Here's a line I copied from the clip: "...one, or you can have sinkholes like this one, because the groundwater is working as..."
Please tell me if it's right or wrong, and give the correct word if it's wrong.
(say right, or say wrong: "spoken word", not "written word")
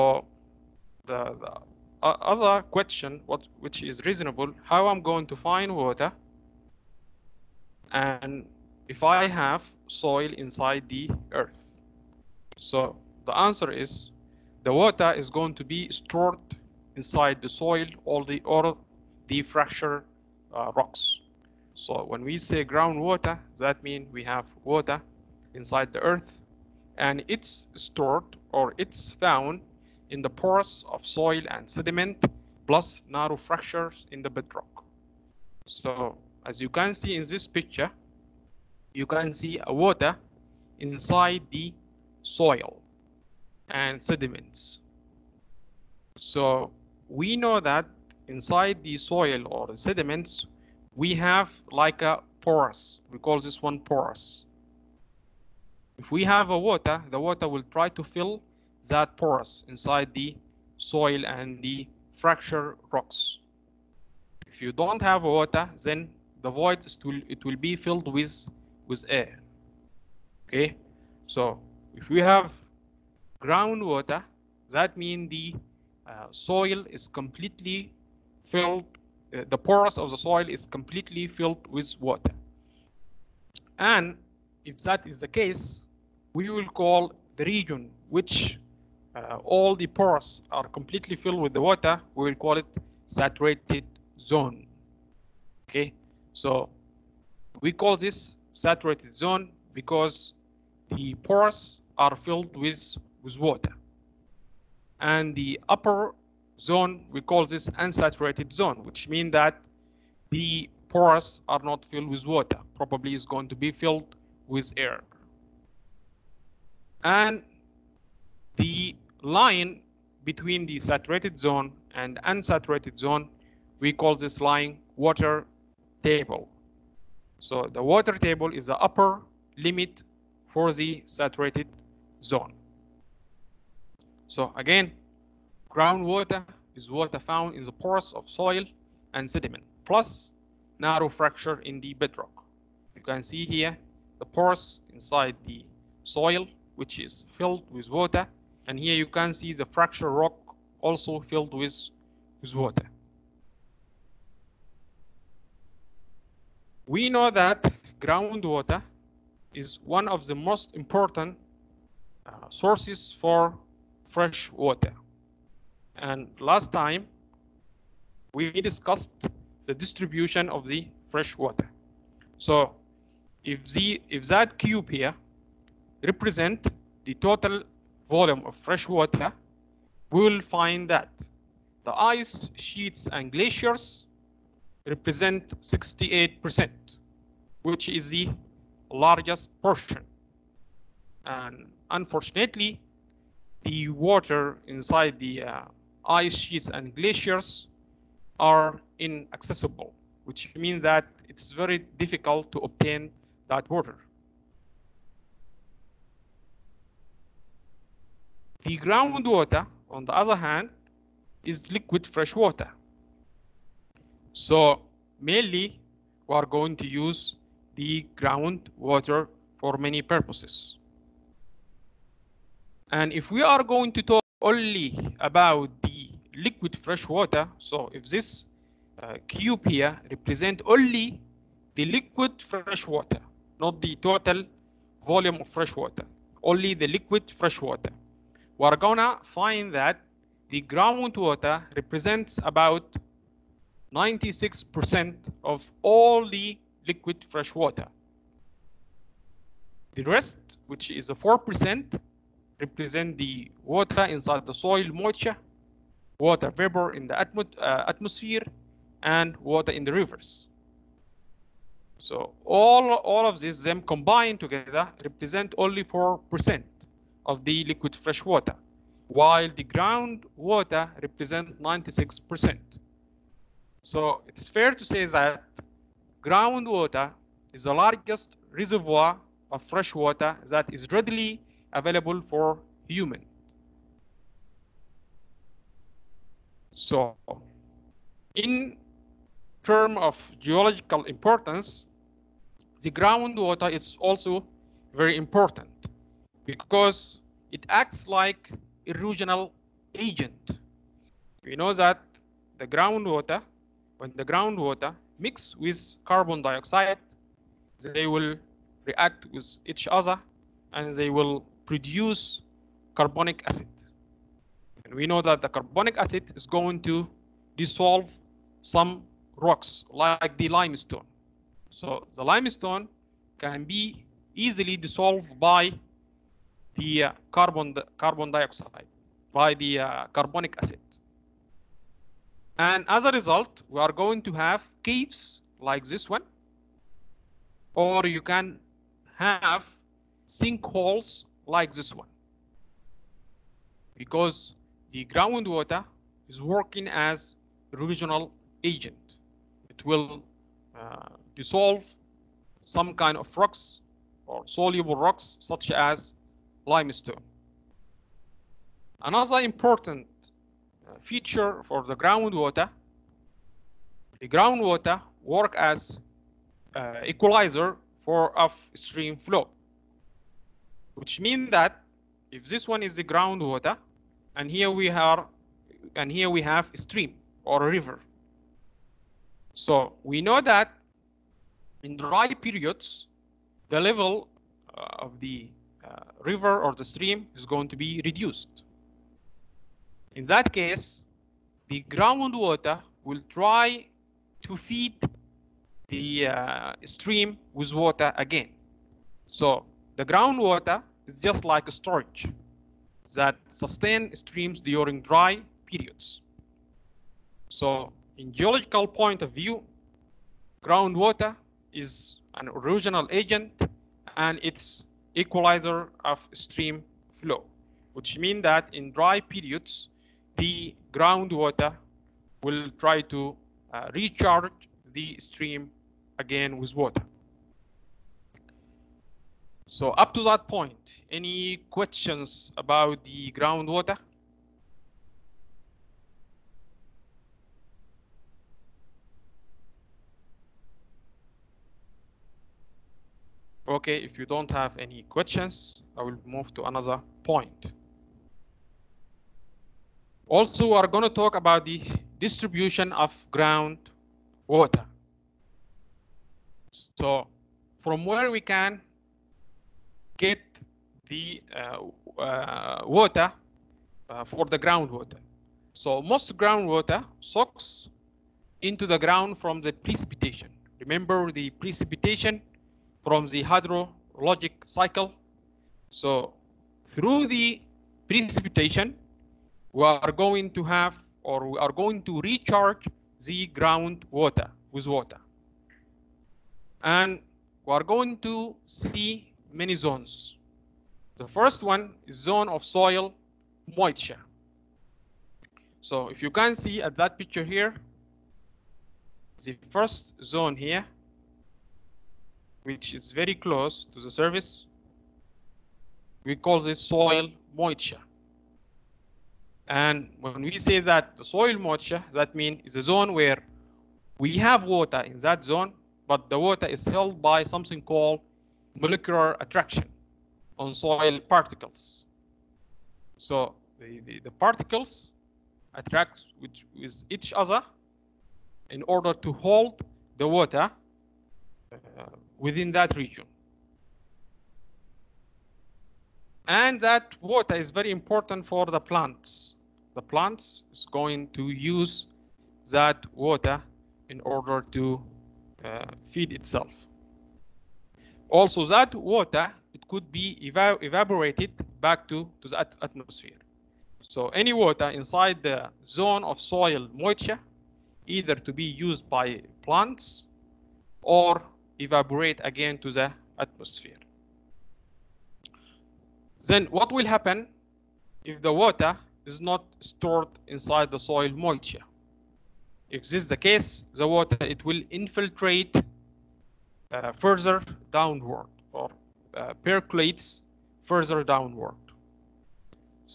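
right.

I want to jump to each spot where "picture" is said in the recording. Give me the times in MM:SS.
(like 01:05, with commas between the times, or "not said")
00:37, 08:17.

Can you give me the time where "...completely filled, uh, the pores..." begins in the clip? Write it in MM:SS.
01:17.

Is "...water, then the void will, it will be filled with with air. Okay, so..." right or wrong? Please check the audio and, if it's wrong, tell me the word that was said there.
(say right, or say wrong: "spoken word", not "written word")
right.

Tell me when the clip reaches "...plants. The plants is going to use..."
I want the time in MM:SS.
08:58.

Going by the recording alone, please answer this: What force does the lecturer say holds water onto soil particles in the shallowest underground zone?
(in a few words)
molecular attraction.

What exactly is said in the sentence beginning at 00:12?
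So the answer is the water is going to be stored inside the soil all the or the fracture uh, rocks.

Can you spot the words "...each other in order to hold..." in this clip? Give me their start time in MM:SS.
08:47.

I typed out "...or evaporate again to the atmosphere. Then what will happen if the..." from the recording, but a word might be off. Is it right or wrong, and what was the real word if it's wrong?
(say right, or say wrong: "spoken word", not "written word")
right.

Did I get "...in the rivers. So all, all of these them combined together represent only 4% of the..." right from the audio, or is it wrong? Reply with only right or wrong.
right.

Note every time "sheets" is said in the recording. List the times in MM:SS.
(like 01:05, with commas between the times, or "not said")
03:02, 03:16.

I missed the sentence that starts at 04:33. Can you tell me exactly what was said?
So it's fair to say that groundwater is the largest reservoir of fresh water that is readily available for human.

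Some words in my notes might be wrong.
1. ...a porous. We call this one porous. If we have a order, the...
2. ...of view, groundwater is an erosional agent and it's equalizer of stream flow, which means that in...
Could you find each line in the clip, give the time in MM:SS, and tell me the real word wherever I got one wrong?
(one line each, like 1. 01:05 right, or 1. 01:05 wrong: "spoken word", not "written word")
1. 00:52 wrong: "water", not "order"
2. 06:49 right.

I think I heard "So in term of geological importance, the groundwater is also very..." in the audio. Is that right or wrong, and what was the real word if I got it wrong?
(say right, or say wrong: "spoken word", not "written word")
right.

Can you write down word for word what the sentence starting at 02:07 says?
So the water table is the upper limit for the saturated zone.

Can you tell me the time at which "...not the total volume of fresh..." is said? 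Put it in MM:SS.
03:53.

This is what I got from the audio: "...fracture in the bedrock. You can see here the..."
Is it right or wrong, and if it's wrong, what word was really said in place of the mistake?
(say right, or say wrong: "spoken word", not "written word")
right.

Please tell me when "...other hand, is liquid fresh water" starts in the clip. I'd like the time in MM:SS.
03:30.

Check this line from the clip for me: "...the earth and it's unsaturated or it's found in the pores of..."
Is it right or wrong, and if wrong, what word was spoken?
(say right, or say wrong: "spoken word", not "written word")
wrong: "stored", not "unsaturated".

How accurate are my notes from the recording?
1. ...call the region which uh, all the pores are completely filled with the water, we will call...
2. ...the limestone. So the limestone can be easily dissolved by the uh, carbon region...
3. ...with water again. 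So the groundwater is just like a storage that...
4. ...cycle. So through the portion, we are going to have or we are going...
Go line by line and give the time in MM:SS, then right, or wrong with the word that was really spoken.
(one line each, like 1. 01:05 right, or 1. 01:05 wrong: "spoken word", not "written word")
1. 01:26 right
2. 05:20 wrong: "carbon", not "region"
3. 06:37 right
4. 07:54 wrong: "precipitation", not "portion".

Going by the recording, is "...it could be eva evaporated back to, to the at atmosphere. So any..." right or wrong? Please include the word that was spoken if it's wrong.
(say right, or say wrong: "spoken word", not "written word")
right.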